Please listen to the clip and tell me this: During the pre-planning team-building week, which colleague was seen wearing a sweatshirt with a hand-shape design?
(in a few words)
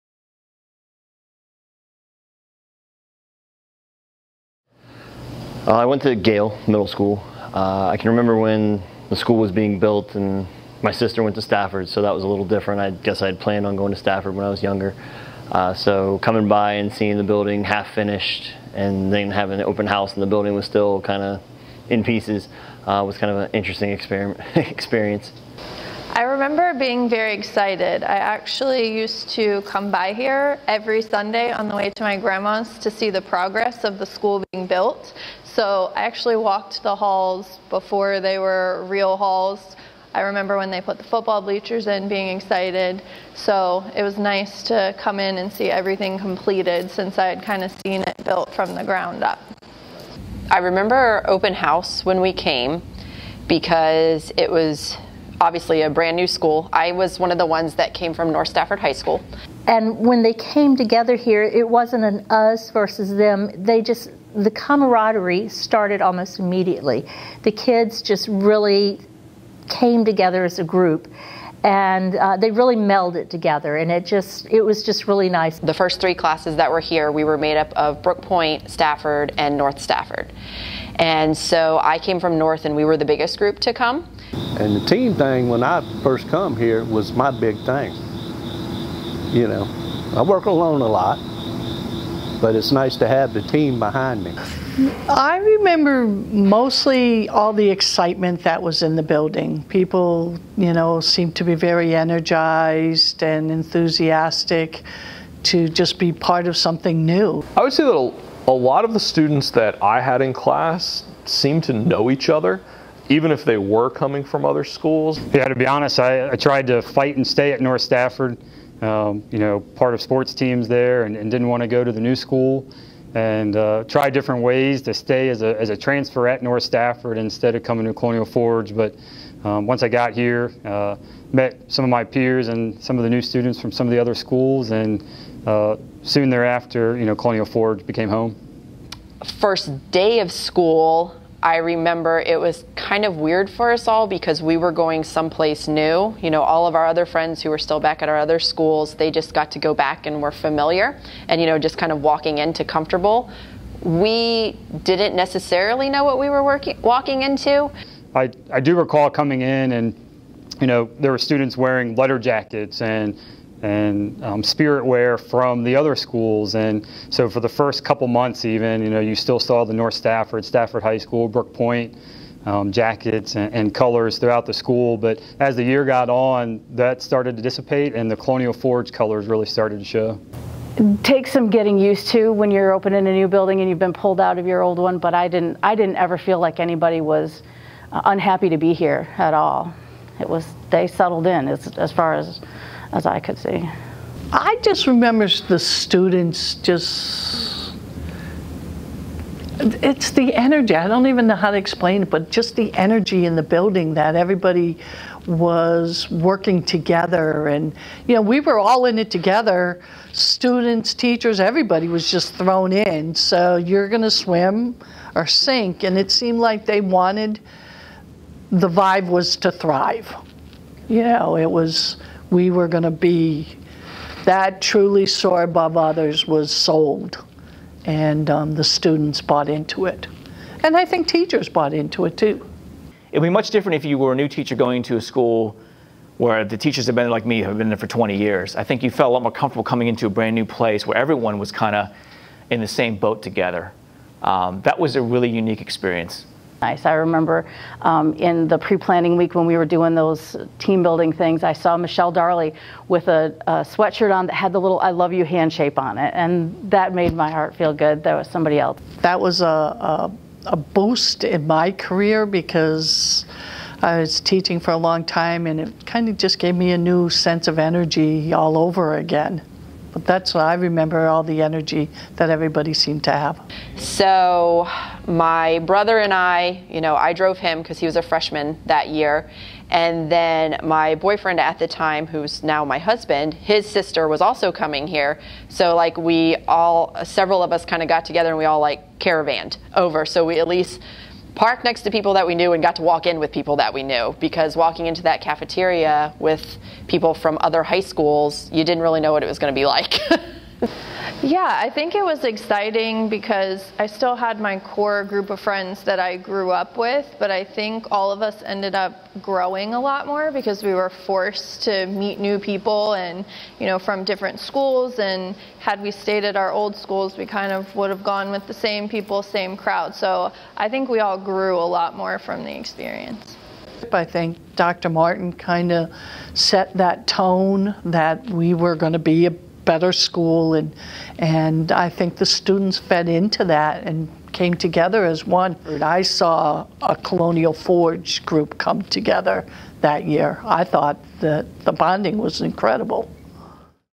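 Michelle Darley.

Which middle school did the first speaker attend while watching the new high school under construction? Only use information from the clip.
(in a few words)
Gayle Middle School.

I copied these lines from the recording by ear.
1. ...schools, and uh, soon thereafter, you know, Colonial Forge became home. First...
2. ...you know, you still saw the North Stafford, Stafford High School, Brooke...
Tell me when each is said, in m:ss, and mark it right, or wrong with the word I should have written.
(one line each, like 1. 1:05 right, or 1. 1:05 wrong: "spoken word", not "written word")
1. 2:14 right
2. 2:48 right.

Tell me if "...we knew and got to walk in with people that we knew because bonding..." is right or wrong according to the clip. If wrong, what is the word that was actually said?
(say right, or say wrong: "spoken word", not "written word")
wrong: "walking", not "bonding".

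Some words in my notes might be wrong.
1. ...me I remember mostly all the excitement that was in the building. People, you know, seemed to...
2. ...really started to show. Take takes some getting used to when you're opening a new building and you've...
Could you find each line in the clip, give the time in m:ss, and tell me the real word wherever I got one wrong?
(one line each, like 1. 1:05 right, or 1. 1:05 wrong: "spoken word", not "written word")
1. 1:34 right
2. 2:59 right.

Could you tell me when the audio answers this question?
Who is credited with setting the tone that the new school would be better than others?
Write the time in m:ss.
5:24.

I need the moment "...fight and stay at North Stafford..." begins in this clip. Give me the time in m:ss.
1:56.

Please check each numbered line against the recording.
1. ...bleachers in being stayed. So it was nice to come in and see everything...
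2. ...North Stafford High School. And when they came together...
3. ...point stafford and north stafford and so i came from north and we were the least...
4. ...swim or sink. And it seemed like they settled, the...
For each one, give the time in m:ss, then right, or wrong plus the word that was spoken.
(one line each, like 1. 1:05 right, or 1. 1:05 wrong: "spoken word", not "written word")
1. 0:41 wrong: "excited", not "stayed"
2. 0:58 right
3. 1:18 wrong: "biggest", not "least"
4. 3:34 wrong: "wanted", not "settled".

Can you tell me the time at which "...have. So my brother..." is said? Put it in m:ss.
4:33.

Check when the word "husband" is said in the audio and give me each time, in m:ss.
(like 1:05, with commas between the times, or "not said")
4:42.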